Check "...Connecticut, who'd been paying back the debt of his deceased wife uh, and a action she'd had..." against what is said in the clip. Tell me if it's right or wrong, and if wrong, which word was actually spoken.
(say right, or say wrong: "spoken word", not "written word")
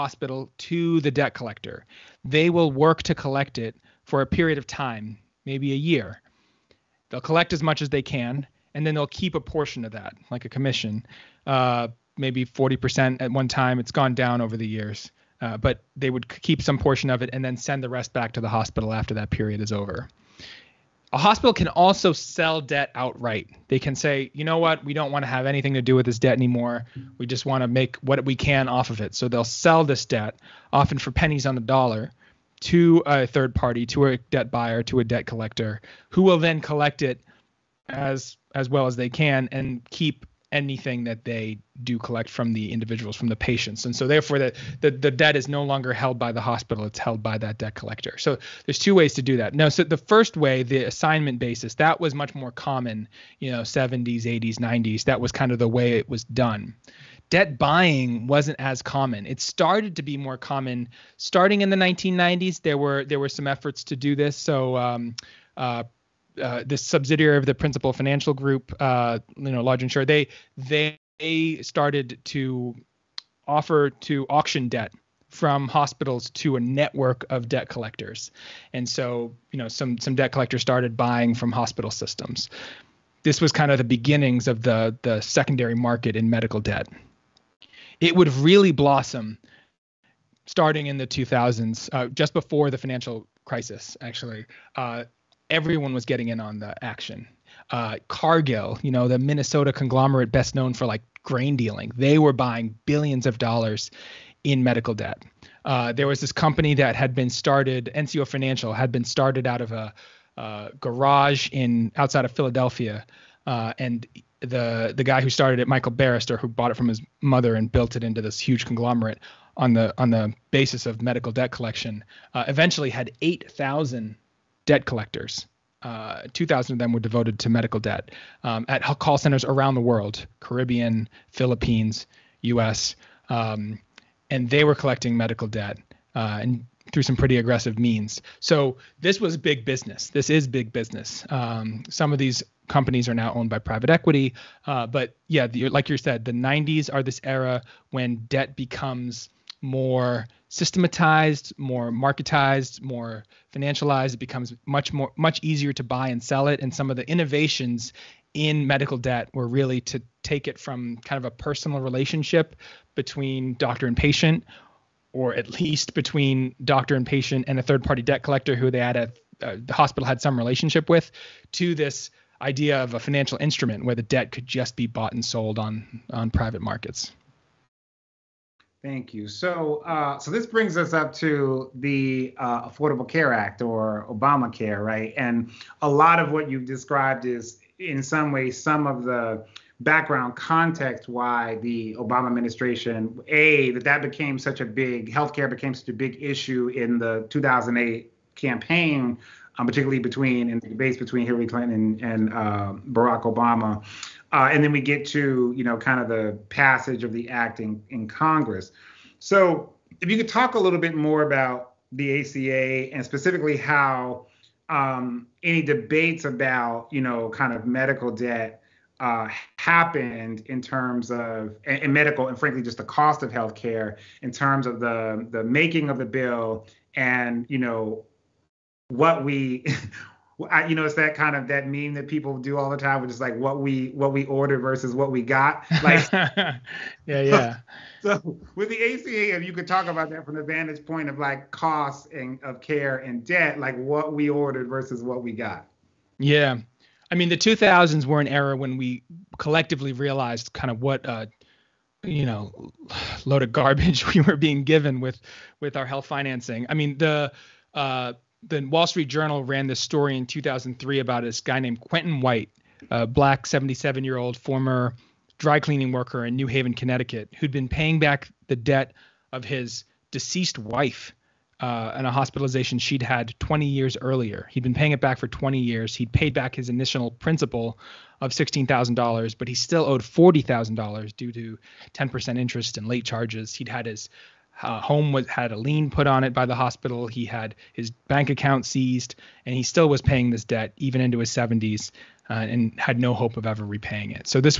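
wrong: "hospitalization", not "action".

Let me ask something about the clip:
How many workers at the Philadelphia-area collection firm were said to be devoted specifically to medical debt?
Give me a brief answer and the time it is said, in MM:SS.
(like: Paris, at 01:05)
2,000, at 02:06.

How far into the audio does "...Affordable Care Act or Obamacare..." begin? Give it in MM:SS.
03:02.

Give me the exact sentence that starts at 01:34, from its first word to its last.
Uh, everyone was getting in on the action.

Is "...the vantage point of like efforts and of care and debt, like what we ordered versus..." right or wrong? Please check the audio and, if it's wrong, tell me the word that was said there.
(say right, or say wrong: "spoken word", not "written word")
wrong: "costs", not "efforts".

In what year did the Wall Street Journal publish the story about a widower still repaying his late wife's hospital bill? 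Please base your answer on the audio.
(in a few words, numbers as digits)
2003.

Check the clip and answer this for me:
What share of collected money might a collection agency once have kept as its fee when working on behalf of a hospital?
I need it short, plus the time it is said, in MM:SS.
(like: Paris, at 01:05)
40%, at 00:12.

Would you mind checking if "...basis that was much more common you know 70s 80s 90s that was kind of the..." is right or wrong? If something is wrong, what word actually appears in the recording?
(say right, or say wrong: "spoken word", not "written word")
right.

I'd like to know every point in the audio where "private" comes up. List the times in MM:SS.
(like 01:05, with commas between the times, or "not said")
02:23, 02:56.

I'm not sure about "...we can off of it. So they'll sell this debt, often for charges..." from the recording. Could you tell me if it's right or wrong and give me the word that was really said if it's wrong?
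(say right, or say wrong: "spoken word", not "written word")
wrong: "pennies", not "charges".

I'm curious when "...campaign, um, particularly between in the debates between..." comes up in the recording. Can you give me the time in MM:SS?
03:18.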